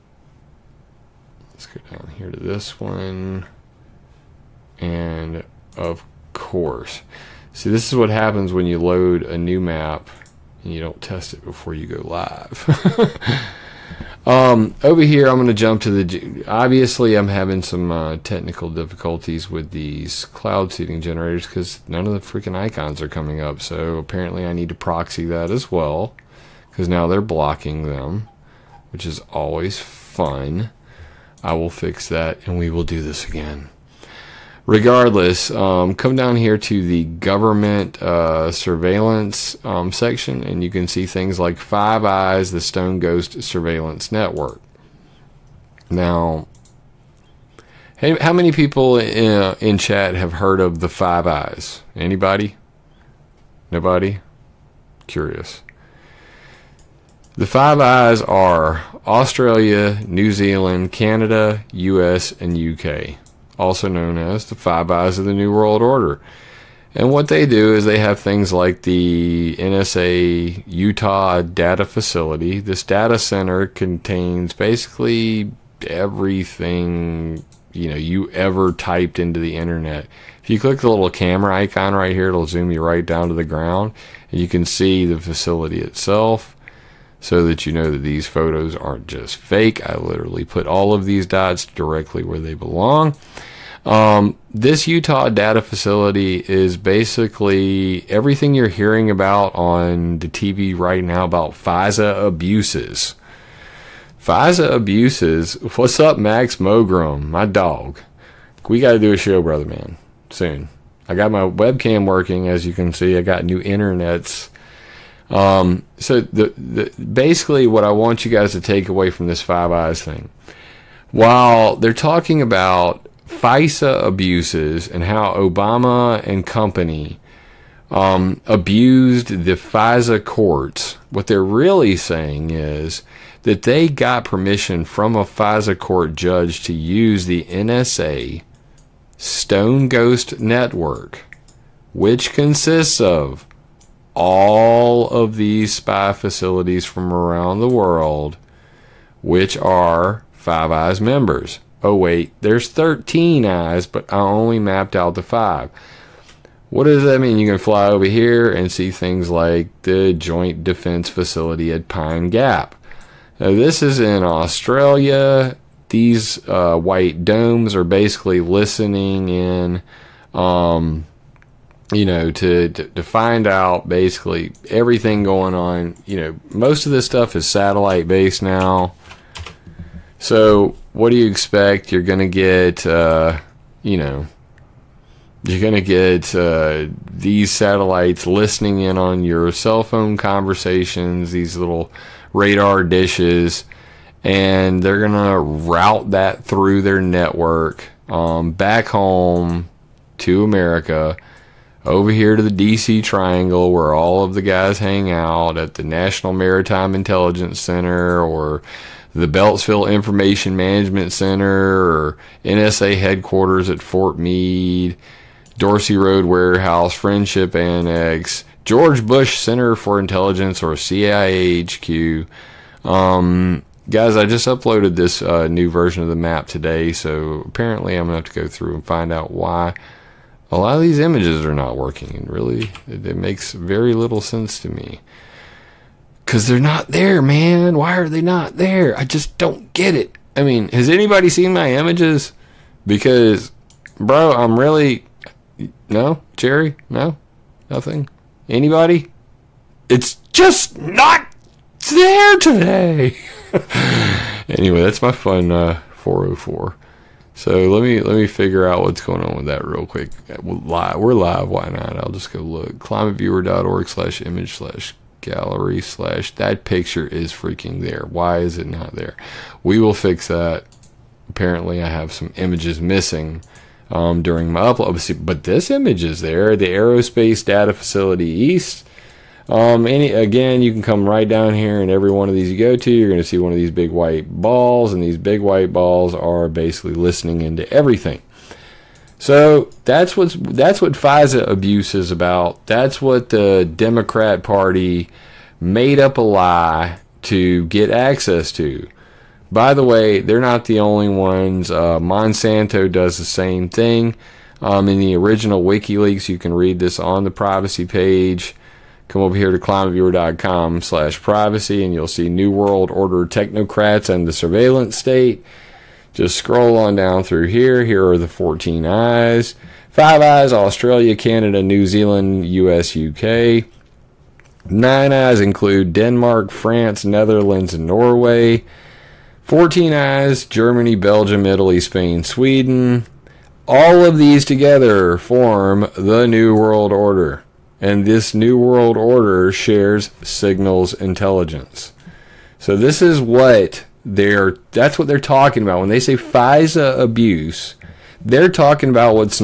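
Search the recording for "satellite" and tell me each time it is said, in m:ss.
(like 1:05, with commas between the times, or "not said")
2:57, 3:07.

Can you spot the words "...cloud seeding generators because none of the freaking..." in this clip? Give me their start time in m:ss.
0:20.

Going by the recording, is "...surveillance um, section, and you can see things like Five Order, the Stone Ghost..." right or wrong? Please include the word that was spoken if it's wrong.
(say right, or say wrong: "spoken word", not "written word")
wrong: "Eyes", not "Order".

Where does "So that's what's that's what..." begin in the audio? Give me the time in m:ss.
4:49.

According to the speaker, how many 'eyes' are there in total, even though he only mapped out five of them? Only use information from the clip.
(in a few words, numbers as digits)
13.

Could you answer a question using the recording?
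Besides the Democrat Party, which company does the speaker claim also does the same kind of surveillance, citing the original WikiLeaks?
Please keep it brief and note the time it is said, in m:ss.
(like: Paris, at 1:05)
Monsanto, at 5:01.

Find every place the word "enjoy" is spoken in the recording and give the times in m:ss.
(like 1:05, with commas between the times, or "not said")
not said.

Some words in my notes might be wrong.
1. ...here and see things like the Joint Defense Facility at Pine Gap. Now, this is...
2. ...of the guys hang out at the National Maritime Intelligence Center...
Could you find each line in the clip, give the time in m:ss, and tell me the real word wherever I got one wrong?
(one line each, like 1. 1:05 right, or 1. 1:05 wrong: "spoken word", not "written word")
1. 2:38 right
2. 3:24 right.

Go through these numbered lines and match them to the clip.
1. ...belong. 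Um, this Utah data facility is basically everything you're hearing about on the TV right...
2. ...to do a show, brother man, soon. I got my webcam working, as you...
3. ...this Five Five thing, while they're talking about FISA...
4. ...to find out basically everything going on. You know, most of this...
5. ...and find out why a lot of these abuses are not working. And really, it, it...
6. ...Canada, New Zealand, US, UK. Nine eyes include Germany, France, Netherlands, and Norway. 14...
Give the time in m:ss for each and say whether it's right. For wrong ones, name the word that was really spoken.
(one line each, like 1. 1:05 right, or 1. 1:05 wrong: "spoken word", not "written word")
1. 1:32 right
2. 1:48 right
3. 1:59 wrong: "Eyes", not "Five"
4. 2:52 right
5. 3:48 wrong: "images", not "abuses"
6. 5:21 wrong: "Denmark", not "Germany".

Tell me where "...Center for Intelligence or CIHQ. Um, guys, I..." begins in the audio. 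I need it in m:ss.
3:39.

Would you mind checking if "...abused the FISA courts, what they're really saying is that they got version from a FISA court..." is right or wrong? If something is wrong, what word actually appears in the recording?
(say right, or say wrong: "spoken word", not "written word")
wrong: "permission", not "version".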